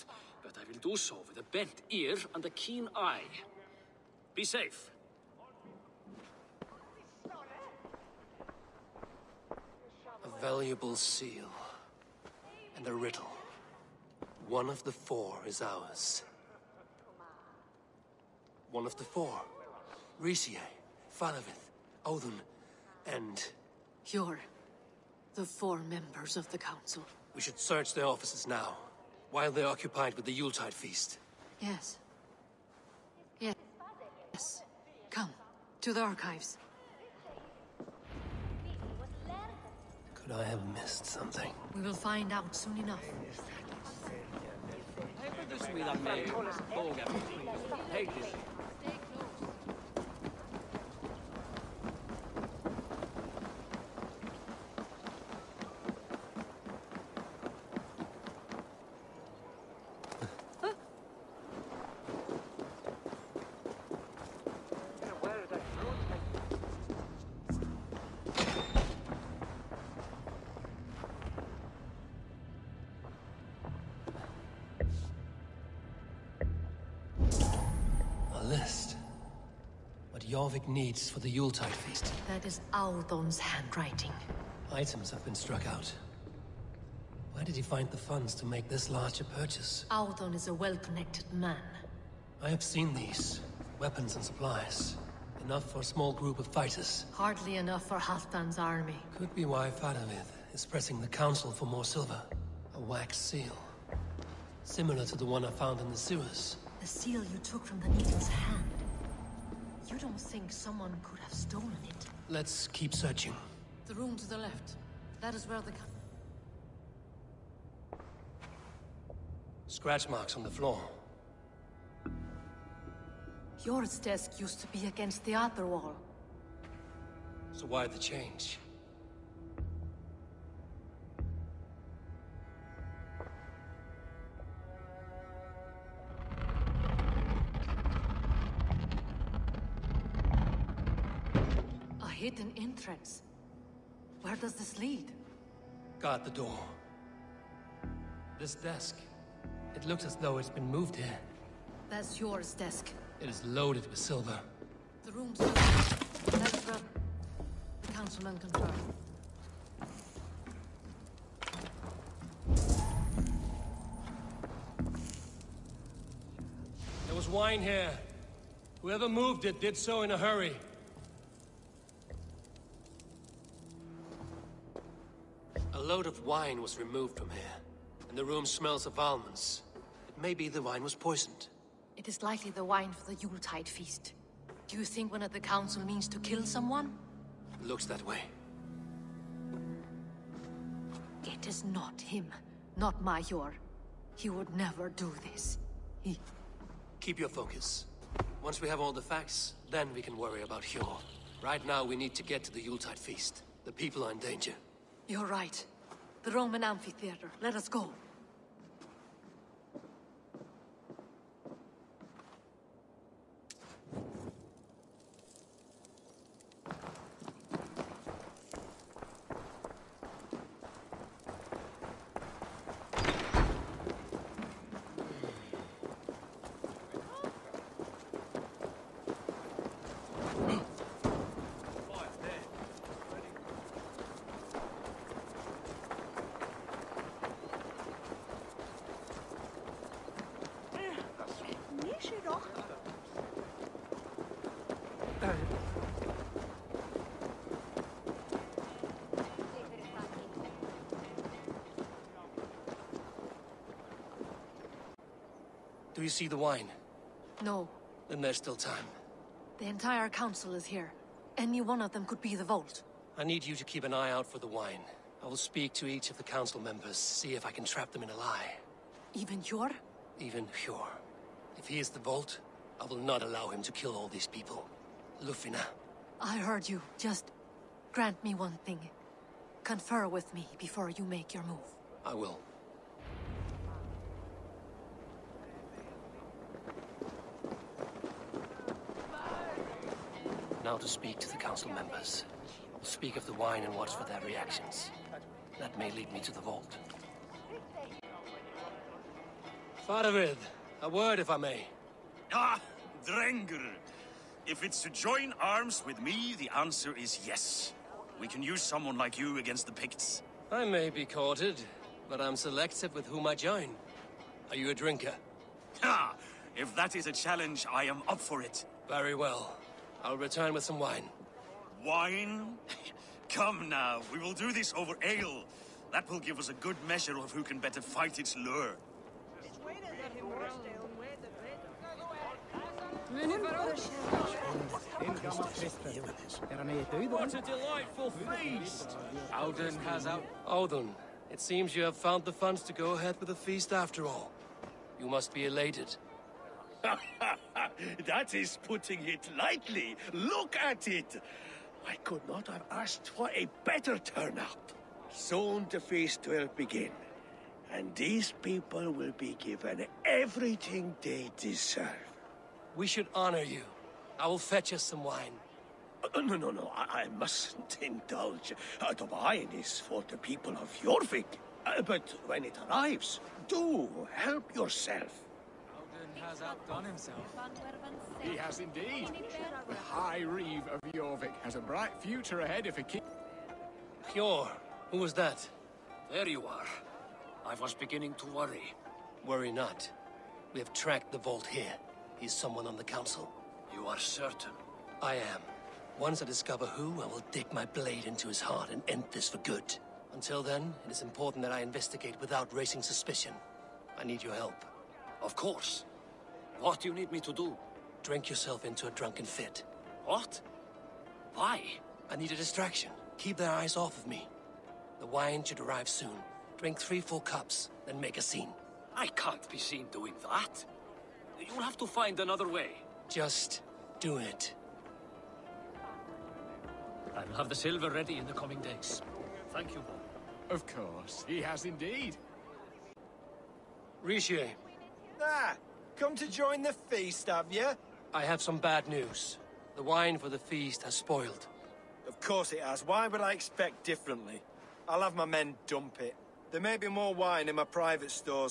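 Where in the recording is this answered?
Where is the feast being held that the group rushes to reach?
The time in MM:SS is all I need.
03:26.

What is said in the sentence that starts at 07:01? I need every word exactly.
You'll have to find another way.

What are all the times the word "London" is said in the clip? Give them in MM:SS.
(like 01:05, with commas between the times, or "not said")
not said.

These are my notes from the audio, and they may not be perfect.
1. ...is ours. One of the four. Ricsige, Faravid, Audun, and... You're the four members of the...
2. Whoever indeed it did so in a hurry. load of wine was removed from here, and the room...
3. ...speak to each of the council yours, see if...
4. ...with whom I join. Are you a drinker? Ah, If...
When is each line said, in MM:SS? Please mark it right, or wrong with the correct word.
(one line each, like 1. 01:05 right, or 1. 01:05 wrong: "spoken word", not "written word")
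1. 00:15 right
2. 02:48 wrong: "moved", not "indeed"
3. 04:25 wrong: "members", not "yours"
4. 05:12 right.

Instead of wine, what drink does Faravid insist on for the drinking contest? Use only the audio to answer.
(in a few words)
Ale.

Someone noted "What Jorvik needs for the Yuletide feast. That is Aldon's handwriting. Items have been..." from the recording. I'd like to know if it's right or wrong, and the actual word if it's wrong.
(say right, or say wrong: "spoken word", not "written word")
right.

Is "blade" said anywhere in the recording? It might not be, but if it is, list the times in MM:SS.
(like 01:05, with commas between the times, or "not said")
06:37.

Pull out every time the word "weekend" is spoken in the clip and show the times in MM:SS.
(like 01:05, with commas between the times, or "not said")
not said.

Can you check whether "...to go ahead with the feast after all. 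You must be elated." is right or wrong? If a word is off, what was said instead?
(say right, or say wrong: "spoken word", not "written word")
right.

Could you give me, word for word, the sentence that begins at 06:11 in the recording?
Uh, but when it arrives, do help yourself has outdone himself.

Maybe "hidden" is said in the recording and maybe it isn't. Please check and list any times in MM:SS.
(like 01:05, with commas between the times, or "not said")
02:22.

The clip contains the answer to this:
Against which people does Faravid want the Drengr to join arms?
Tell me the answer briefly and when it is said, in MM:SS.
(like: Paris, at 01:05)
The Picts, at 05:09.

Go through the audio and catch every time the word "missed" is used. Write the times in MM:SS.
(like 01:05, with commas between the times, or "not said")
00:40.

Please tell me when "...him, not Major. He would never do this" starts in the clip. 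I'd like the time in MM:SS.
03:11.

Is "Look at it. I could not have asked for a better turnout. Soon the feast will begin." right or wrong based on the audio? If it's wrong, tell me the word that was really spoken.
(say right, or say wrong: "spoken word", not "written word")
right.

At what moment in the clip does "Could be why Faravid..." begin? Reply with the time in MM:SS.
01:39.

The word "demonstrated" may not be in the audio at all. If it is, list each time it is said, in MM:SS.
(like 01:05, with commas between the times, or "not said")
not said.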